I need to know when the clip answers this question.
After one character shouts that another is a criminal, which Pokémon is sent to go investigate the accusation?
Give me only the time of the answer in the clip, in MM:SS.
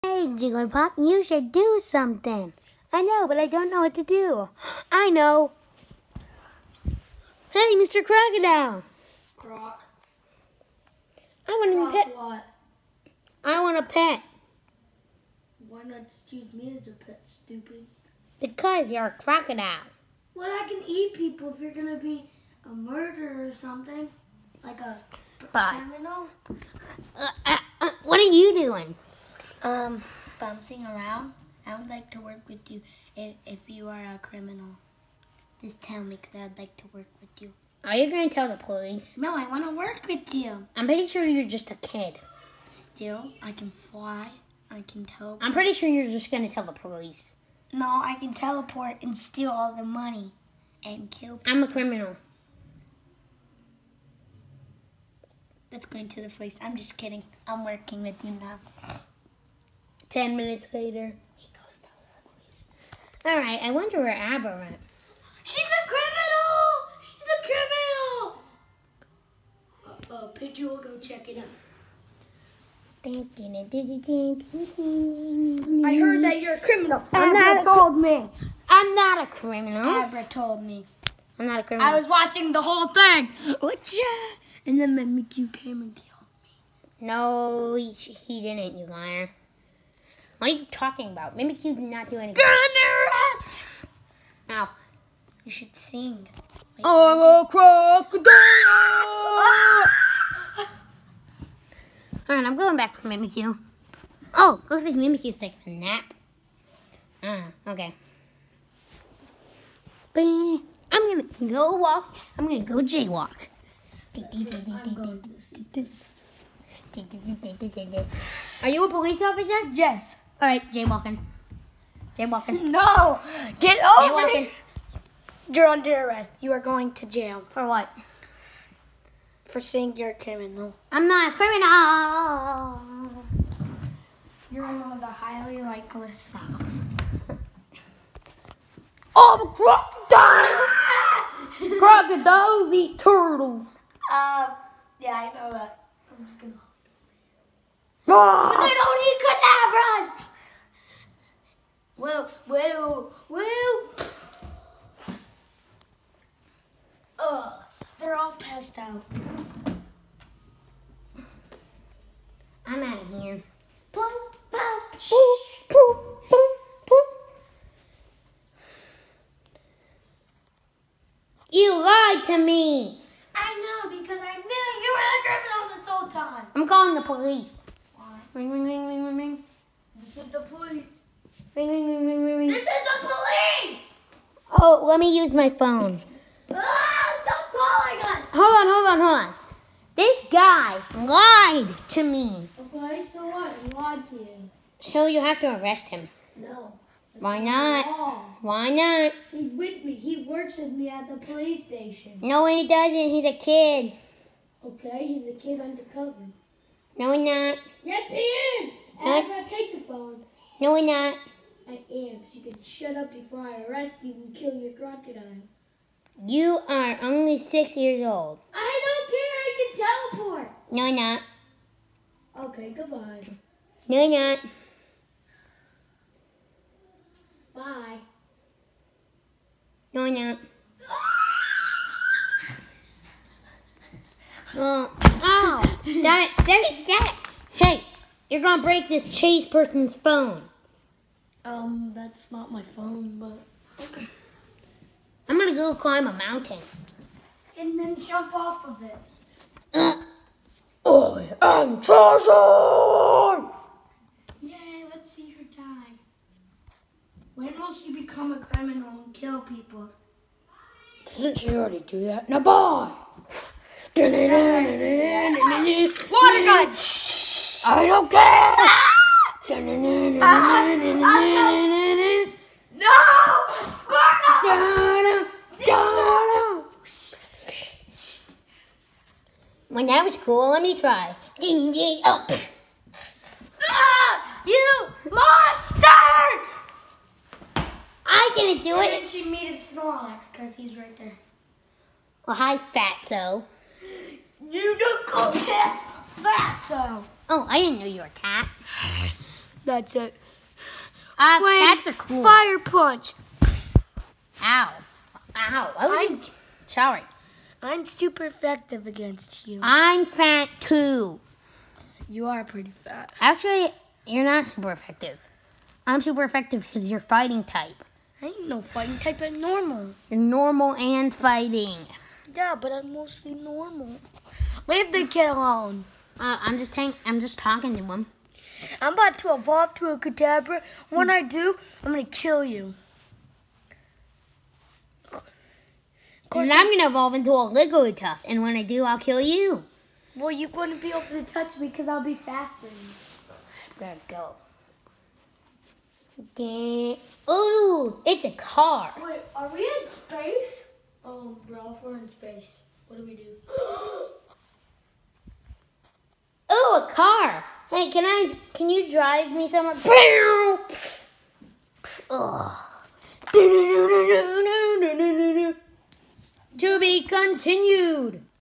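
01:10.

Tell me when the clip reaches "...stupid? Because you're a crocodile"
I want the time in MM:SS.
00:17.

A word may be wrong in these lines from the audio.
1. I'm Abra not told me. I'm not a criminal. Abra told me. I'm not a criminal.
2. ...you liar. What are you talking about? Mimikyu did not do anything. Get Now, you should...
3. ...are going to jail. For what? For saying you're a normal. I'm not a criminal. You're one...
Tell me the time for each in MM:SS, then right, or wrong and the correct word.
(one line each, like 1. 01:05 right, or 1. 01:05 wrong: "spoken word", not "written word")
1. 01:17 right
2. 01:28 right
3. 02:06 wrong: "criminal", not "normal".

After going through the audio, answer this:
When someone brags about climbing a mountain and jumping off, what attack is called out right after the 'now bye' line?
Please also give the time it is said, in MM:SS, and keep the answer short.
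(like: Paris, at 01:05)
Water Gun, at 04:23.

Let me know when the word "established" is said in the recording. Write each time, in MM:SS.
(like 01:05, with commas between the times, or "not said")
not said.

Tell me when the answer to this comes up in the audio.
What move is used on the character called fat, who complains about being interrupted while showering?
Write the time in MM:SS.
05:02.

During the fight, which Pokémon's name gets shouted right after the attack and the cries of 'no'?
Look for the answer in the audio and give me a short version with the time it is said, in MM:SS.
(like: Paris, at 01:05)
Squirtle, at 04:33.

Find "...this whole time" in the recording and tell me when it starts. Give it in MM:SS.
02:55.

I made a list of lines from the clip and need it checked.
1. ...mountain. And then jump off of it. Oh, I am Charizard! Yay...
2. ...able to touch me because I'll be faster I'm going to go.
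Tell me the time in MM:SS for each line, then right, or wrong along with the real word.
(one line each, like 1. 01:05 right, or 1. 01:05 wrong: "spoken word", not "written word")
1. 04:06 right
2. 05:40 right.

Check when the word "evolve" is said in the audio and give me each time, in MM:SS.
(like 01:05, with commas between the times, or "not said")
05:29, 05:36.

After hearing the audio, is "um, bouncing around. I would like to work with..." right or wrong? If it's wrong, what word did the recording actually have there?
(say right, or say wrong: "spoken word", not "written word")
right.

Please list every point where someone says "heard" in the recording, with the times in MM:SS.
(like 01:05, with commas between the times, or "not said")
01:15.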